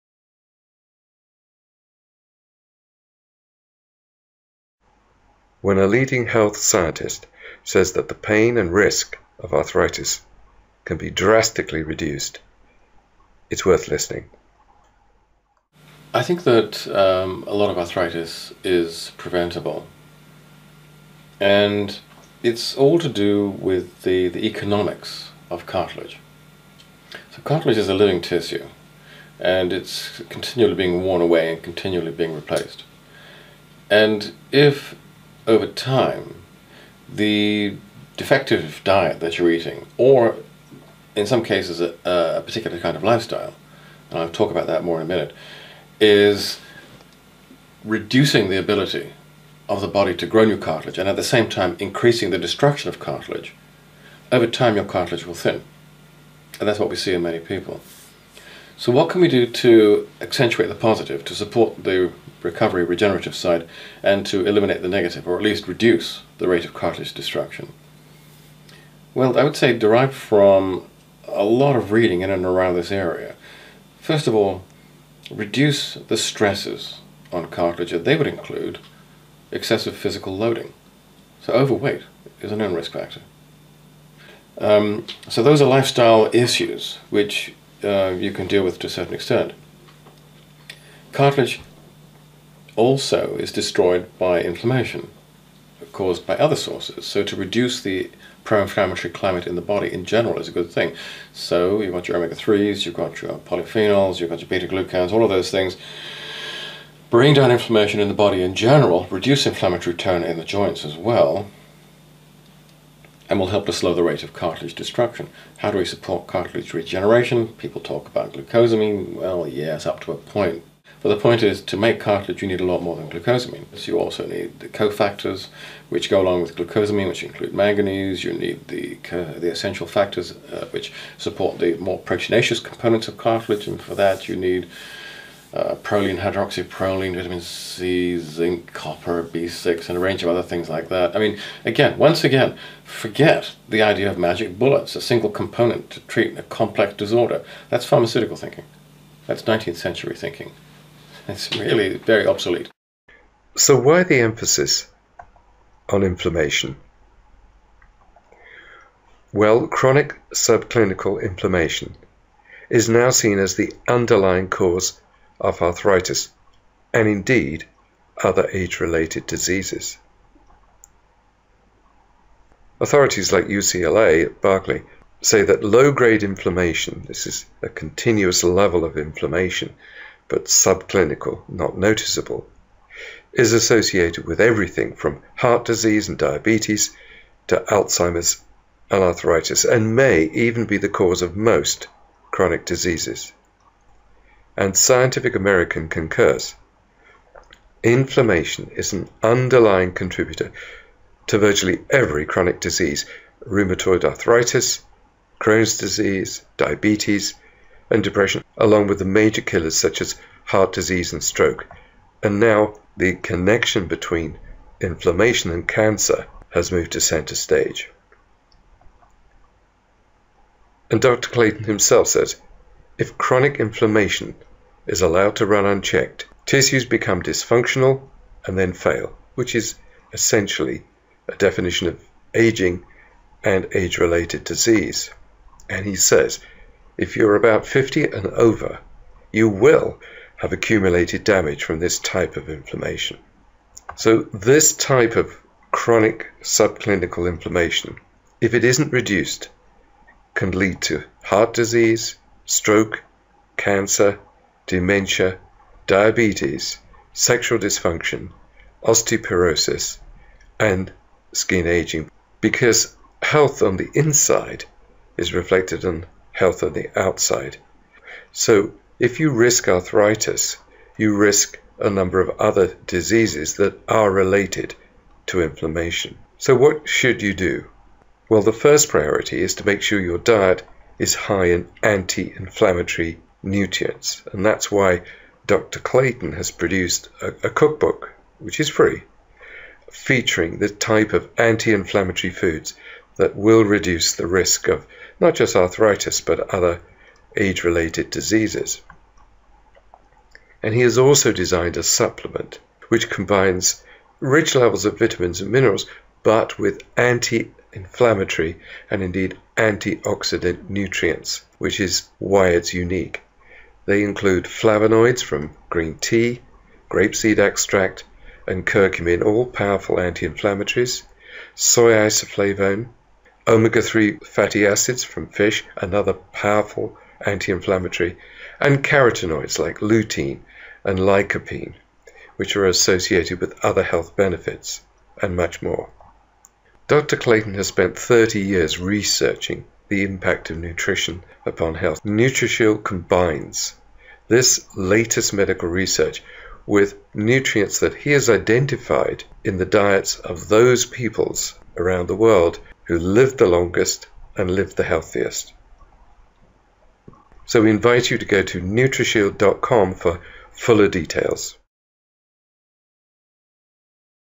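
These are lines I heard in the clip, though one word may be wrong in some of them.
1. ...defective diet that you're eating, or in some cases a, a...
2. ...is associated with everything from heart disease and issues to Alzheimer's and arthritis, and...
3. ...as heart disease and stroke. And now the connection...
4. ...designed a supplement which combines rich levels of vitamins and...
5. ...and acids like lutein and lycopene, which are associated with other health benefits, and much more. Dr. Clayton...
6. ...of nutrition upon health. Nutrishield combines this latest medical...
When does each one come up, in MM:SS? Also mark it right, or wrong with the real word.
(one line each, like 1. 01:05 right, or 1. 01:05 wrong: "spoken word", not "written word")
1. 00:38 right
2. 03:03 wrong: "diabetes", not "issues"
3. 03:29 right
4. 05:01 right
5. 05:28 wrong: "carotenoids", not "acids"
6. 05:40 right.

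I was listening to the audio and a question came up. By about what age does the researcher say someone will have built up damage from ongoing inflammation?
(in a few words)
50.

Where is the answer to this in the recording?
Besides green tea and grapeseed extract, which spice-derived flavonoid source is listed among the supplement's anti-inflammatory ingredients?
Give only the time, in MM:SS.
05:18.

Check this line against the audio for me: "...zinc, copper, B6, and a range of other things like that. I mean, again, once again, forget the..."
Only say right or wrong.
right.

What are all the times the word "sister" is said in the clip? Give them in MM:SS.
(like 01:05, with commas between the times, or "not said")
not said.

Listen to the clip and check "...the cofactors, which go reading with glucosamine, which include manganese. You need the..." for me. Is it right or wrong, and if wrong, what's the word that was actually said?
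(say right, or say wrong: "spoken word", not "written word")
wrong: "along", not "reading".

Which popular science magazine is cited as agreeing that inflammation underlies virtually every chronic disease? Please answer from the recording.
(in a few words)
Scientific American.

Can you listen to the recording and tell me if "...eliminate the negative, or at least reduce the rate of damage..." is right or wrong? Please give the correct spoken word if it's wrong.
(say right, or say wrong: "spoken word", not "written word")
wrong: "cartilage", not "damage".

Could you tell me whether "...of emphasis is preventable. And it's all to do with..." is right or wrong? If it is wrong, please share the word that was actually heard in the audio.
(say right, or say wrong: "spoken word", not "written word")
wrong: "arthritis", not "emphasis".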